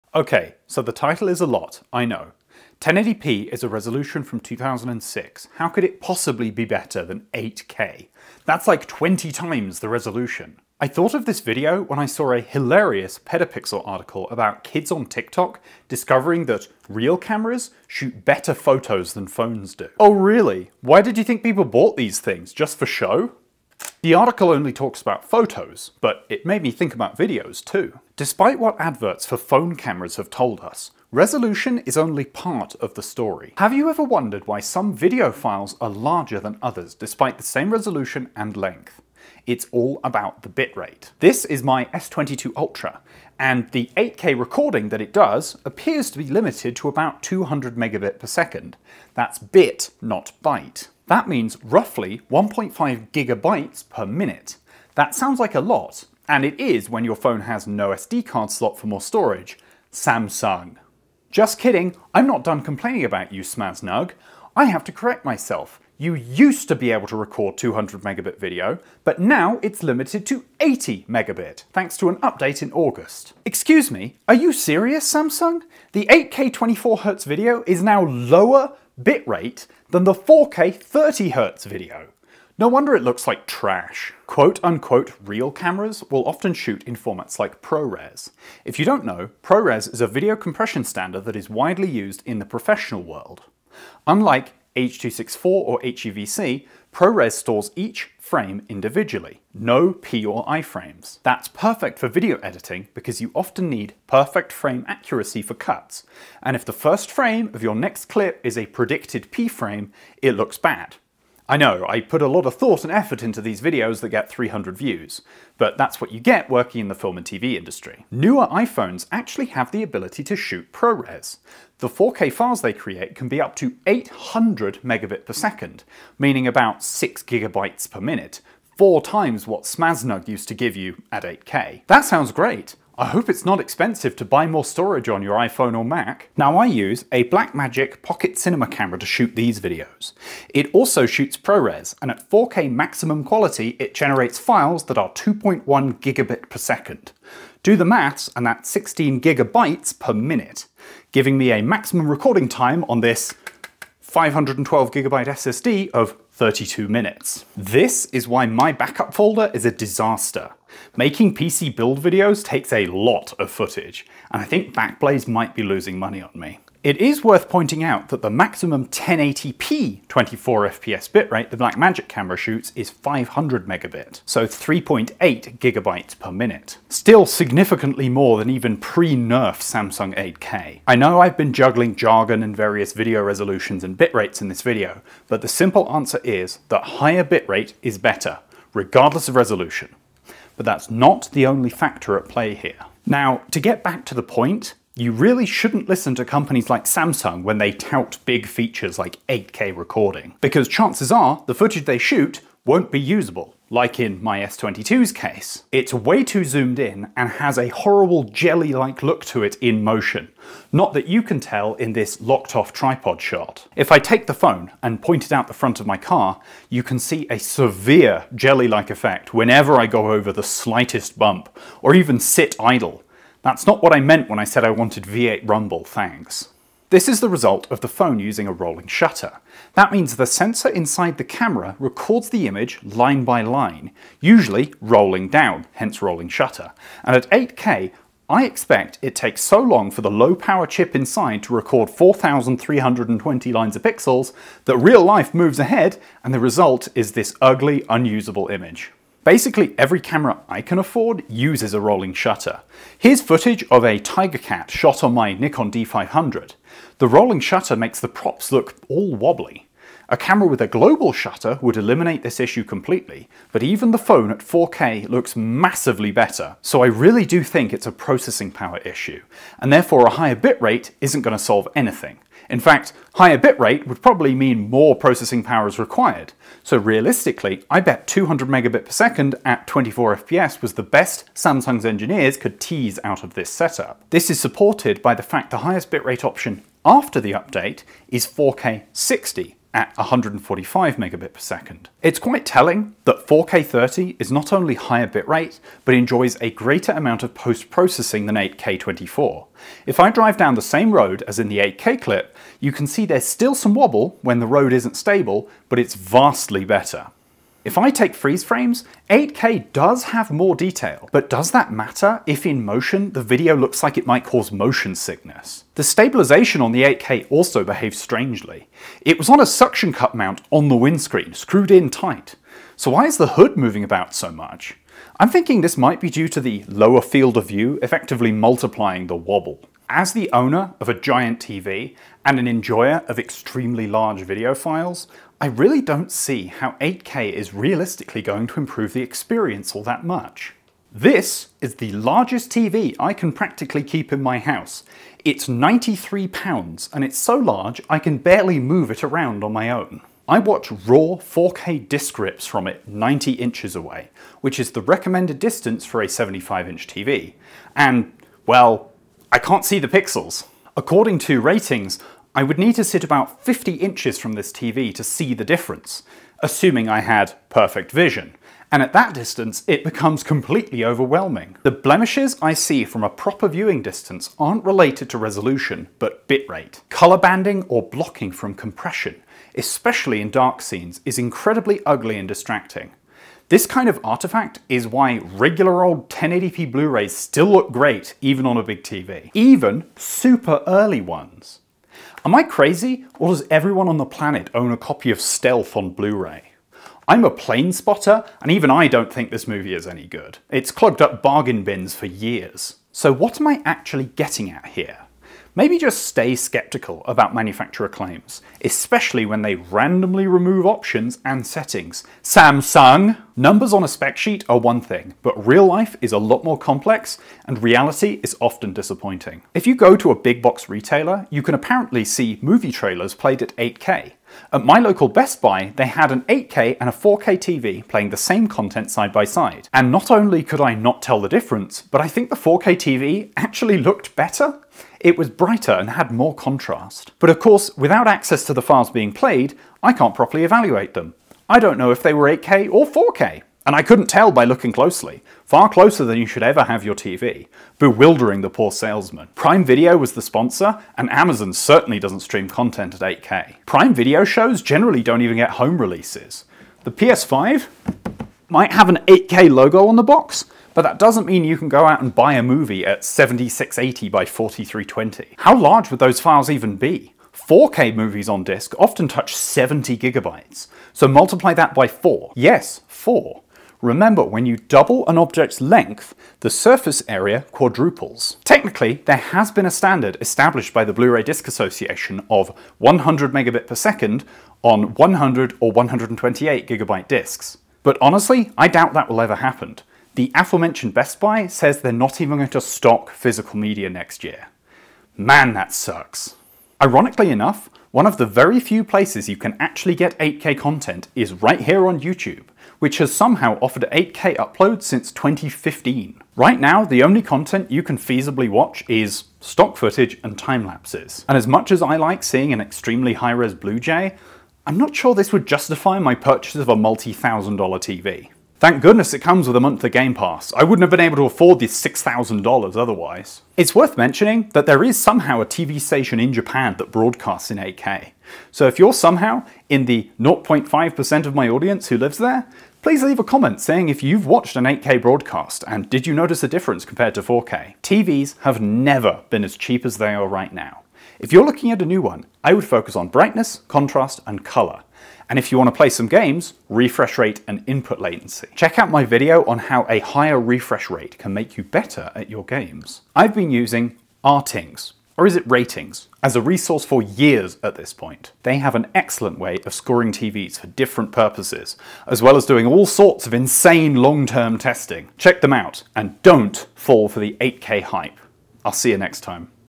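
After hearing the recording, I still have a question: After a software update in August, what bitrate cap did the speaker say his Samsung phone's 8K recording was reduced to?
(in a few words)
80 megabit.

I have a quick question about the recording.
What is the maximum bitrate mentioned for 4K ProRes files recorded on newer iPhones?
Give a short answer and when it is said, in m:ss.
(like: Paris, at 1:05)
800 megabit per second, at 2:03.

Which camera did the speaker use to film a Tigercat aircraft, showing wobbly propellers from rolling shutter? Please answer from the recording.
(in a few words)
Nikon D500.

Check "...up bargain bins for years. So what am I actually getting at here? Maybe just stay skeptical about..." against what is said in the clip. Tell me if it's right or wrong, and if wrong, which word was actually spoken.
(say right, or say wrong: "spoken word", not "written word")
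right.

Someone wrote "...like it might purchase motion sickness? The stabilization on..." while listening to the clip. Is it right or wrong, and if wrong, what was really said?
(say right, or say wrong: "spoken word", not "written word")
wrong: "cause", not "purchase".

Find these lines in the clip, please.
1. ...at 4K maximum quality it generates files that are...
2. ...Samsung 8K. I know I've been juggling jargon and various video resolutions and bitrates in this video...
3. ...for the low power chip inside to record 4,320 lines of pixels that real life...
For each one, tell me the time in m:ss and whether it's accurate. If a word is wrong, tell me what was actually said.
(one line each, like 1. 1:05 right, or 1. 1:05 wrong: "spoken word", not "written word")
1. 2:22 right
2. 2:59 right
3. 3:59 right.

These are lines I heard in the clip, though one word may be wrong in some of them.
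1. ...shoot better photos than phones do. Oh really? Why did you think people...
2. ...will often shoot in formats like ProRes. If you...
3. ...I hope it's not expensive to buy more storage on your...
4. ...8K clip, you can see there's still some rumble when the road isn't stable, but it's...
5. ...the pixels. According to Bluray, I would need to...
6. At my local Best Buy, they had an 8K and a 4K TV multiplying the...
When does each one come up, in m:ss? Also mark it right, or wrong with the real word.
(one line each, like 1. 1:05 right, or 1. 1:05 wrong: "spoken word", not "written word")
1. 0:17 right
2. 1:26 right
3. 2:13 right
4. 5:01 wrong: "wobble", not "rumble"
5. 5:59 wrong: "RTINGS", not "Bluray"
6. 7:04 wrong: "playing", not "multiplying".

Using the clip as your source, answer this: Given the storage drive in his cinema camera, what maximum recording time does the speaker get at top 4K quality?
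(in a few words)
32 minutes.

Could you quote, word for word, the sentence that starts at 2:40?
Making PC build videos takes a lot of footage, and I think Backblaze might be losing money on me.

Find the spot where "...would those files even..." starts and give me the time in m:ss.
7:45.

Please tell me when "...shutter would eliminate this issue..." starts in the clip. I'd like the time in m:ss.
4:21.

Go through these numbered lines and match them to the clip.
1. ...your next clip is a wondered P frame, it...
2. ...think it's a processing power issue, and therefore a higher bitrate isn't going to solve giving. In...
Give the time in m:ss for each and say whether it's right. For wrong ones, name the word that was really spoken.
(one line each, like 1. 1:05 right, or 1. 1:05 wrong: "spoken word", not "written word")
1. 1:47 wrong: "predicted", not "wondered"
2. 4:27 wrong: "anything", not "giving".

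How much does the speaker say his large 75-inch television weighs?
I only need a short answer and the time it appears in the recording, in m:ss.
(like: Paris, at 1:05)
93 pounds, at 5:45.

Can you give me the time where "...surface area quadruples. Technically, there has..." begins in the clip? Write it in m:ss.
7:56.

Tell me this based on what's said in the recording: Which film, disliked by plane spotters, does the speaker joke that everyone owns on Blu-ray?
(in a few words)
Stealth.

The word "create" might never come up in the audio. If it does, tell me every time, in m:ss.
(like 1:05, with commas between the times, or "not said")
2:02.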